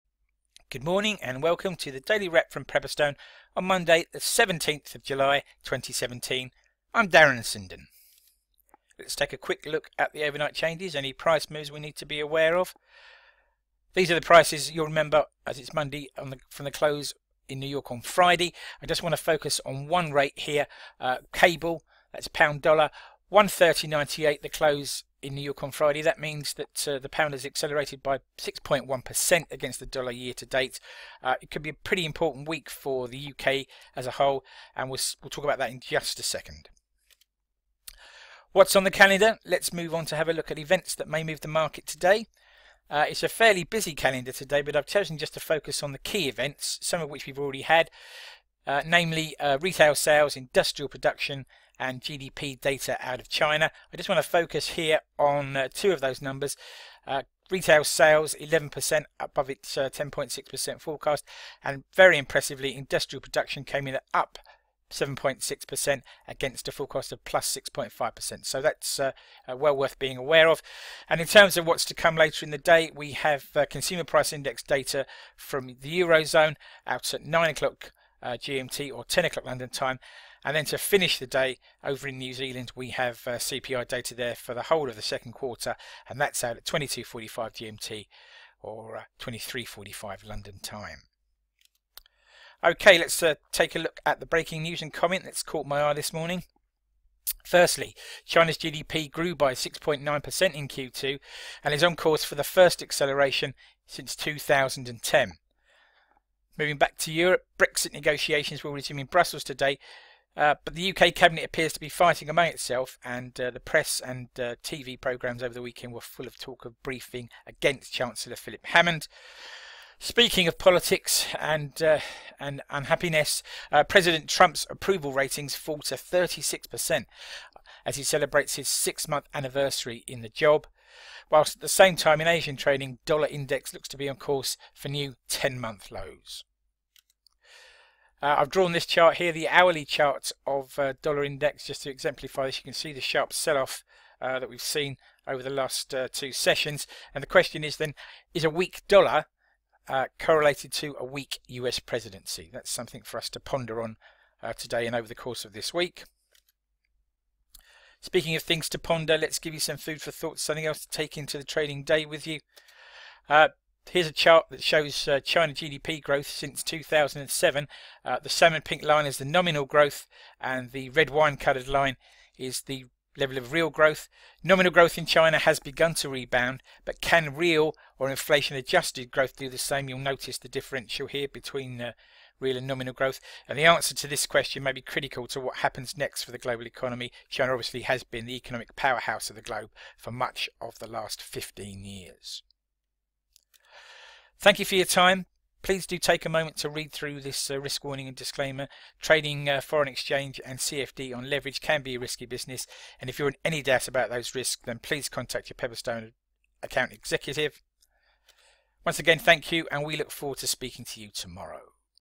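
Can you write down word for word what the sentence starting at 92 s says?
Okay, let's uh, take a look at the breaking news and comment that's caught my eye this morning.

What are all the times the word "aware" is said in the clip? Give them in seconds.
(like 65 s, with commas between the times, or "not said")
12 s, 70 s.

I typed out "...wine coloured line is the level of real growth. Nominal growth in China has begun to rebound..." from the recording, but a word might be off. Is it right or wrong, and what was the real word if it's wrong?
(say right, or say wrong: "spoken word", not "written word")
right.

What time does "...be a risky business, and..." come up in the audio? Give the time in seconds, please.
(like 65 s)
201 s.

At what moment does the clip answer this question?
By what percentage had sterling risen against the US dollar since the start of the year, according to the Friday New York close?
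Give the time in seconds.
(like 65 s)
28 s.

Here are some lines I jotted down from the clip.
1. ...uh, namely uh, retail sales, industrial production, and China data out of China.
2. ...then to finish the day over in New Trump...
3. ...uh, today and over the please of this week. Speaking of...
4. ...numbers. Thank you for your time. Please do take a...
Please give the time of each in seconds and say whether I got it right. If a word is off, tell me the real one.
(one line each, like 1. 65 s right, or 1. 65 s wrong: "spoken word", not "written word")
1. 48 s wrong: "GDP", not "China"
2. 80 s wrong: "Zealand", not "Trump"
3. 154 s wrong: "course", not "please"
4. 191 s wrong: "years", not "numbers".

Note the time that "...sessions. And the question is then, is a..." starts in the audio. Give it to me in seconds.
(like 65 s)
146 s.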